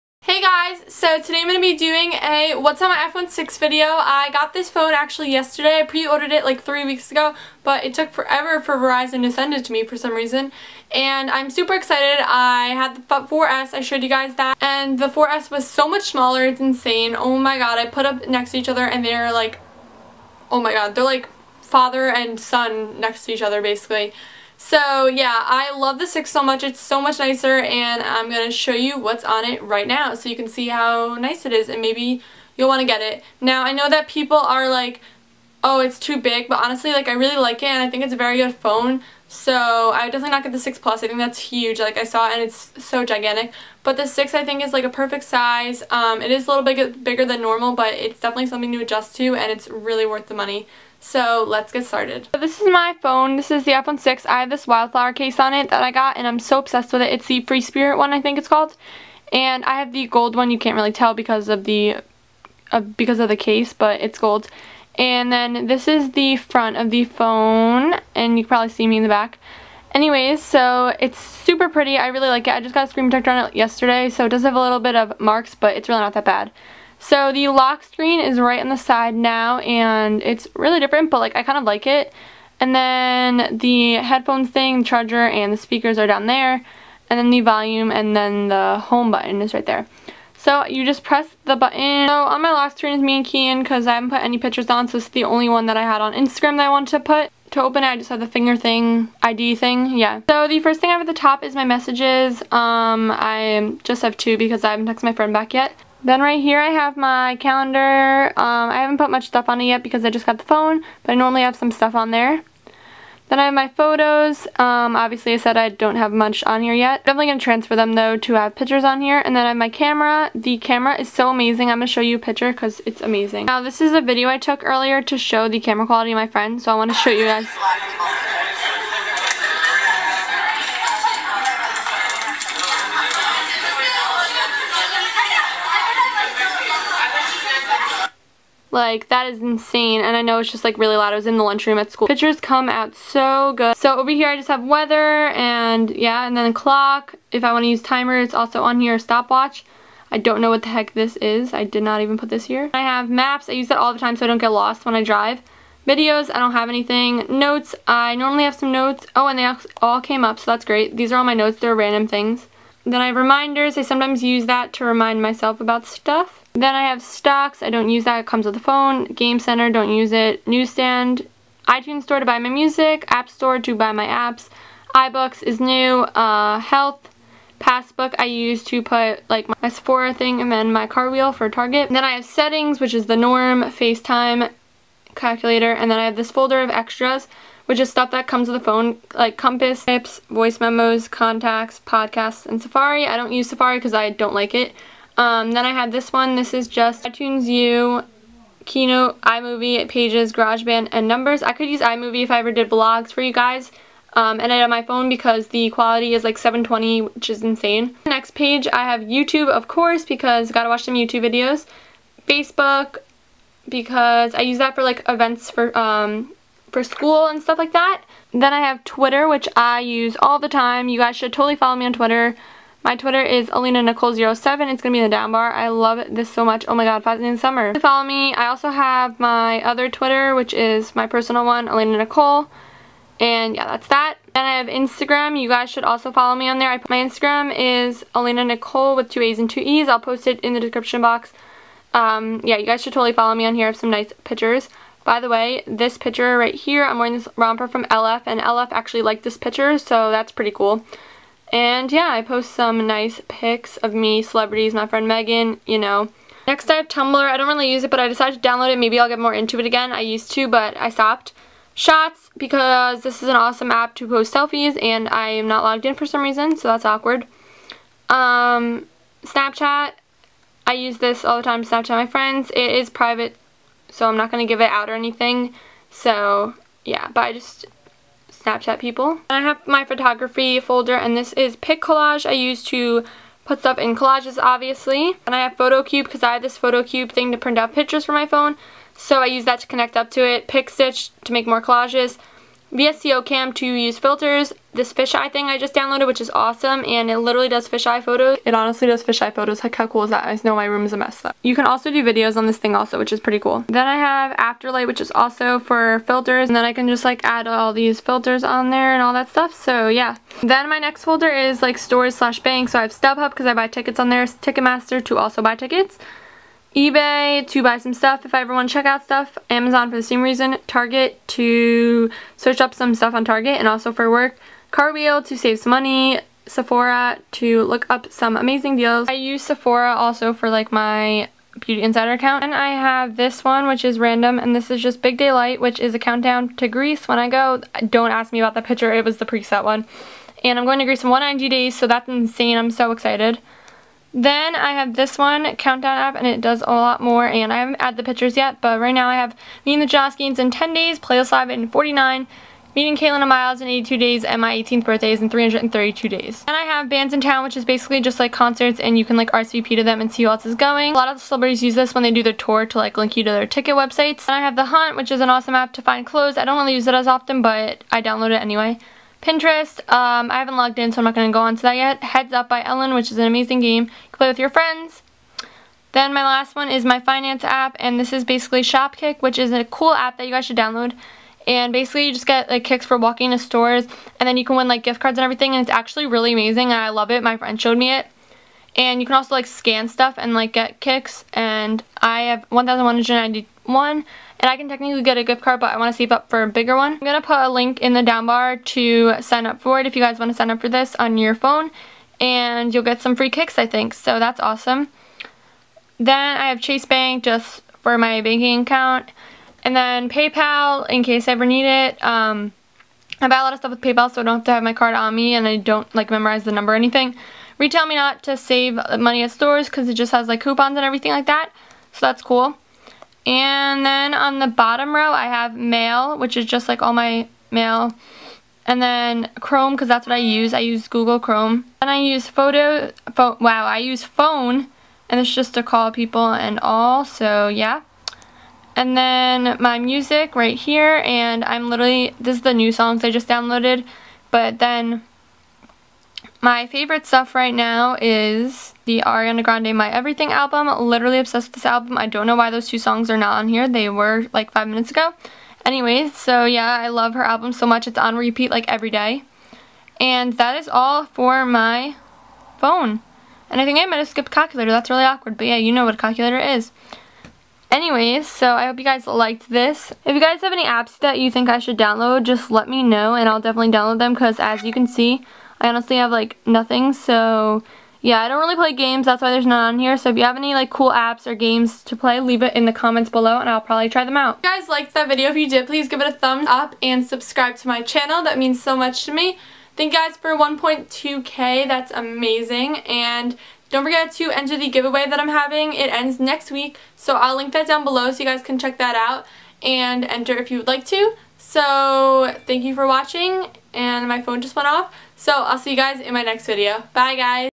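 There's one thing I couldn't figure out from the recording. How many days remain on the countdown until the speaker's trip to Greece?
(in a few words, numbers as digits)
190.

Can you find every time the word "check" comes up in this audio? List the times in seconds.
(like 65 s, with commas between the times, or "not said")
318 s, 498 s.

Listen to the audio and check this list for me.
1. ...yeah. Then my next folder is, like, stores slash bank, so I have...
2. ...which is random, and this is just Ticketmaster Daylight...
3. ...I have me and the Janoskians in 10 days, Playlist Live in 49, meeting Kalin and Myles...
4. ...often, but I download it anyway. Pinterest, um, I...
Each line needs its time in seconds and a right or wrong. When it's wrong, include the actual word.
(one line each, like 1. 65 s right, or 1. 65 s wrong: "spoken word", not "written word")
1. 309 s right
2. 333 s wrong: "Big", not "Ticketmaster"
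3. 349 s right
4. 367 s right.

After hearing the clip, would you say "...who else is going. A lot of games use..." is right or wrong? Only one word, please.
wrong.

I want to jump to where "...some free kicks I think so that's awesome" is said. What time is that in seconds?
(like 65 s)
403 s.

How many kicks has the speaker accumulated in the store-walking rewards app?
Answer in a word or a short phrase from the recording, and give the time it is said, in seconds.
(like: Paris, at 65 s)
1,191, at 392 s.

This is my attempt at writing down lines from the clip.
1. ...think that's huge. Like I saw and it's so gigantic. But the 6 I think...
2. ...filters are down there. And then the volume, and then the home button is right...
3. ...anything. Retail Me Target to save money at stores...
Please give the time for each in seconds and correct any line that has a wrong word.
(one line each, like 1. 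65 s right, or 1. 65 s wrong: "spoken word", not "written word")
1. 41 s right
2. 85 s wrong: "speakers", not "filters"
3. 416 s wrong: "Not", not "Target".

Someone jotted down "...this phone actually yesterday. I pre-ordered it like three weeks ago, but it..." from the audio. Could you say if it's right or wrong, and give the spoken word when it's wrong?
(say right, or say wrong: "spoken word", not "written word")
right.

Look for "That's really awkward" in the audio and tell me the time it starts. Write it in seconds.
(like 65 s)
464 s.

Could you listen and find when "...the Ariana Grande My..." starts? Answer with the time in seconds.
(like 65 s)
448 s.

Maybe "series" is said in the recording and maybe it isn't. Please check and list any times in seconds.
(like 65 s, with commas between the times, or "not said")
not said.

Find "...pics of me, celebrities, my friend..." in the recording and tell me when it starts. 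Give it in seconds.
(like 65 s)
253 s.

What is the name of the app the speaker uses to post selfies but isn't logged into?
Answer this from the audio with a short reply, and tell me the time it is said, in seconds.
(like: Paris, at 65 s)
Shots, at 261 s.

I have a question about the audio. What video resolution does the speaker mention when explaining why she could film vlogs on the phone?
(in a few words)
720.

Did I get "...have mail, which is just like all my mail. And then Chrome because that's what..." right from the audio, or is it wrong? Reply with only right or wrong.
right.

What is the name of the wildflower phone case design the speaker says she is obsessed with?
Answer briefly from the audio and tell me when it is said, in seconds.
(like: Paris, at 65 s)
Free Spirit, at 57 s.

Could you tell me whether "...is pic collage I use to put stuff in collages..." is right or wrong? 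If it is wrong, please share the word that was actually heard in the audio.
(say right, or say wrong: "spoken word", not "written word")
right.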